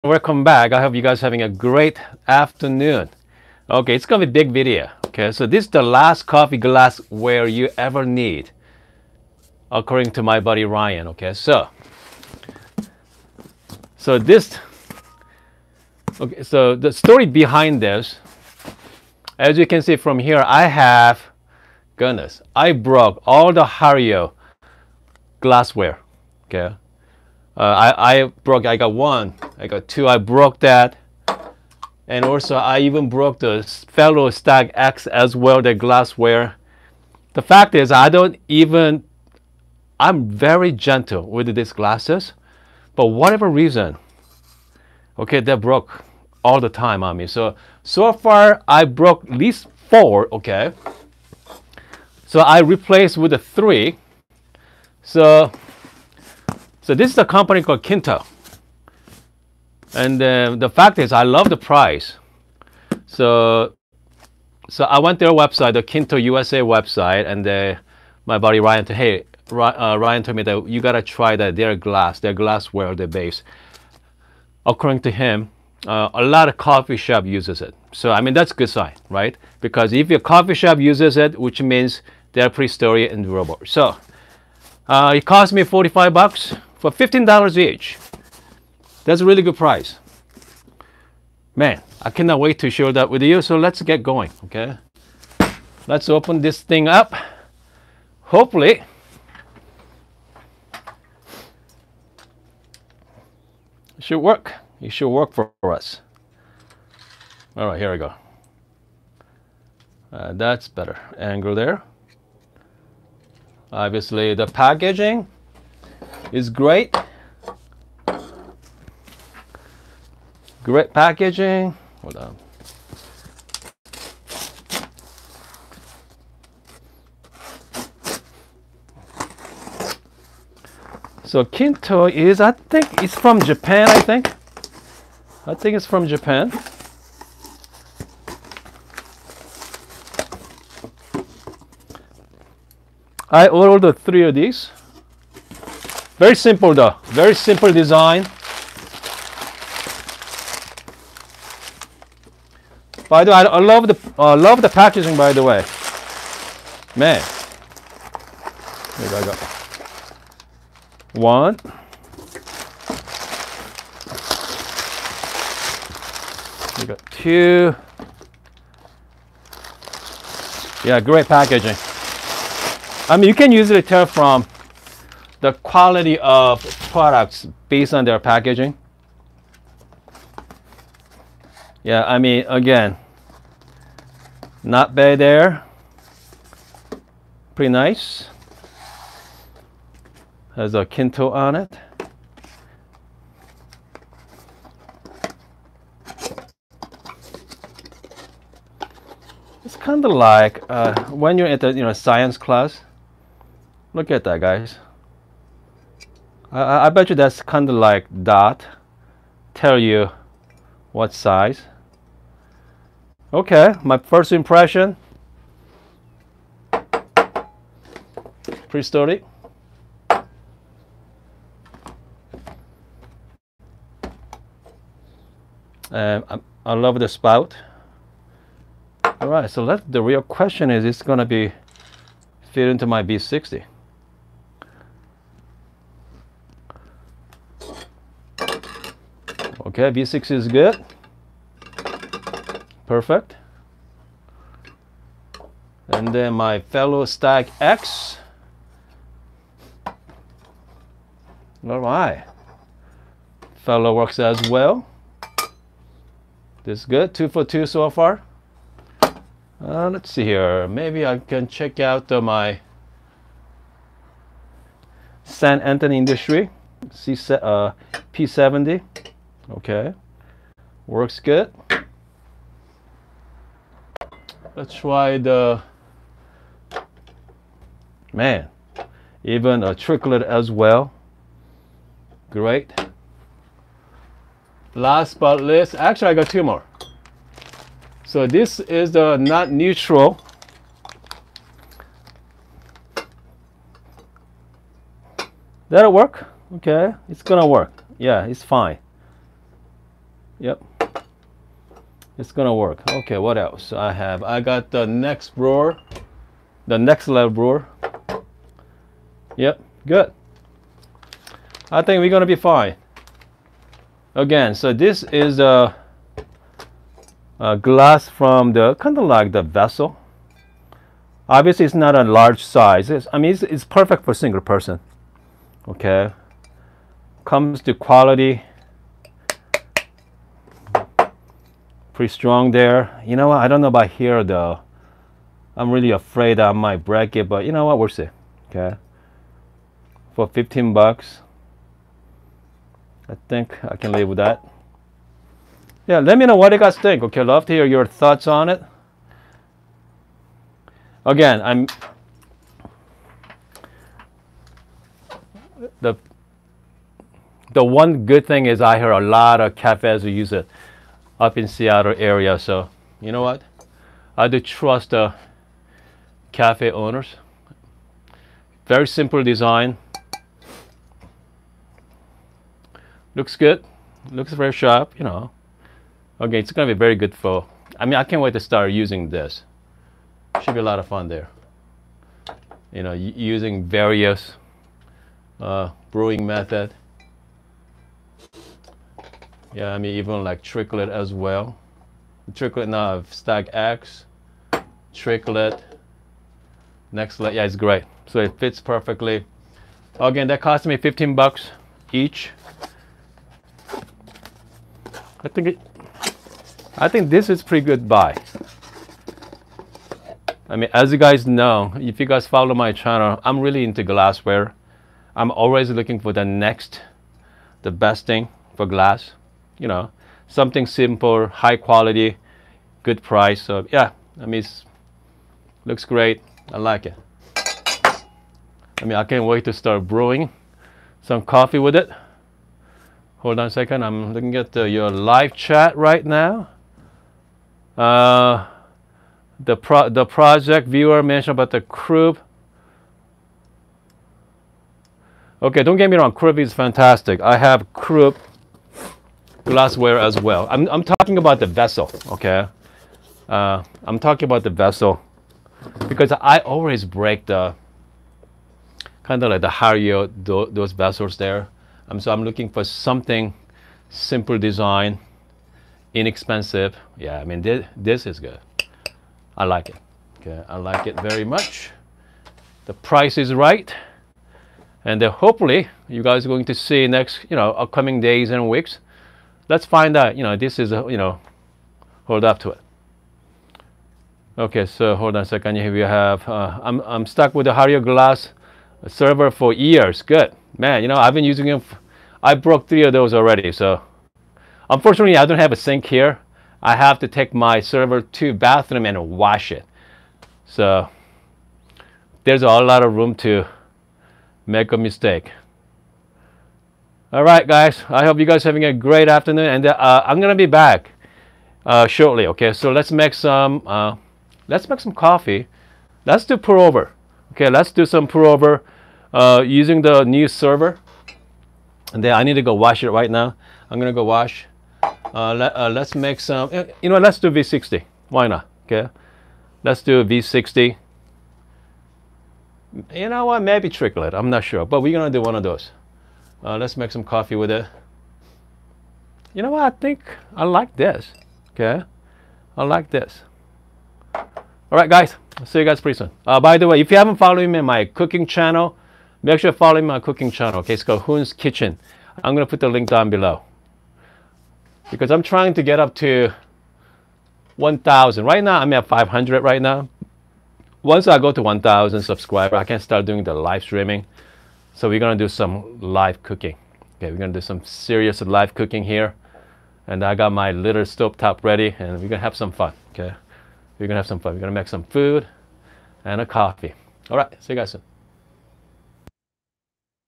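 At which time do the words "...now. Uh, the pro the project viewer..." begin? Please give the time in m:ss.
7:16.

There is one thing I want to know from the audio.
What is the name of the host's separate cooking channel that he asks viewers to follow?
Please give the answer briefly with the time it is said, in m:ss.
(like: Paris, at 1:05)
Hoon's Kitchen, at 9:11.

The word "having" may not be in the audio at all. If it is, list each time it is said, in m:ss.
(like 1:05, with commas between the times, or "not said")
0:01, 8:28.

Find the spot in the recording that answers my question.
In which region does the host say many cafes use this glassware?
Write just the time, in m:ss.
6:01.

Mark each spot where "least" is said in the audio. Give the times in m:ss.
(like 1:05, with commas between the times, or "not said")
0:49, 4:45.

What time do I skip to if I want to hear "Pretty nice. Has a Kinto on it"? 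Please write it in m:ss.
3:07.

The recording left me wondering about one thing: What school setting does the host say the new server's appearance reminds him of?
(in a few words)
science class.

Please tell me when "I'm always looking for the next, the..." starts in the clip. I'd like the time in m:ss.
6:55.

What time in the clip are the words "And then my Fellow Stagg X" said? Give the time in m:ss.
4:05.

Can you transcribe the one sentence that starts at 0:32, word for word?
And also I even broke the Fellow Stagg X as well, the glassware.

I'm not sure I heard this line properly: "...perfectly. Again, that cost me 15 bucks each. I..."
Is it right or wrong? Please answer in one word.
right.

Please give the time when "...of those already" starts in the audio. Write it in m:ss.
8:12.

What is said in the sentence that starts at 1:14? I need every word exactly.
According to him, uh, a lot of coffee shop uses it.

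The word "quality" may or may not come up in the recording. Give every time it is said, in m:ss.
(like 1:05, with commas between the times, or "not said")
2:55, 5:27, 7:01.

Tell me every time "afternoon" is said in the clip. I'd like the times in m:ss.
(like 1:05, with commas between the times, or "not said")
0:02, 8:29.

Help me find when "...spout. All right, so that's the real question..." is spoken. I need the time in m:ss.
3:47.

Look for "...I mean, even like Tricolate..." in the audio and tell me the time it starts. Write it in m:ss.
6:29.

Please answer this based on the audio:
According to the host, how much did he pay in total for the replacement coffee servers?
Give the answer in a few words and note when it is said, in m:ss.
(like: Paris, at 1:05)
$45, at 1:25.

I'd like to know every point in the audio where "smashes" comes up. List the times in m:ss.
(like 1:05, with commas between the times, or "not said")
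not said.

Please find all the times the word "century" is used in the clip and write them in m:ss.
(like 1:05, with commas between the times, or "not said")
not said.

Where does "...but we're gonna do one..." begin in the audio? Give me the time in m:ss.
8:54.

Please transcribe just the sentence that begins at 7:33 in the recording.
Uh, I'm talking about the vessel because I always break the kind of like the Hario, those vessels there.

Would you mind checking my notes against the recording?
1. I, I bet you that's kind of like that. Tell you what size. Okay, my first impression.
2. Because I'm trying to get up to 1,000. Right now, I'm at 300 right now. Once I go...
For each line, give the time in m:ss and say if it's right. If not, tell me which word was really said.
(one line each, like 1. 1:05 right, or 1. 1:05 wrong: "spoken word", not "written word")
1. 3:26 right
2. 9:14 wrong: "500", not "300".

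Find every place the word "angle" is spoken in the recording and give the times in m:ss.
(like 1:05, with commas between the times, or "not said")
1:51.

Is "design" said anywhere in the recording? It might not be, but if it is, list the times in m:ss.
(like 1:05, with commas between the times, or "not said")
2:27, 6:09, 7:44.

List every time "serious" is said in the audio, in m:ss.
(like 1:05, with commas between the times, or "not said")
9:27.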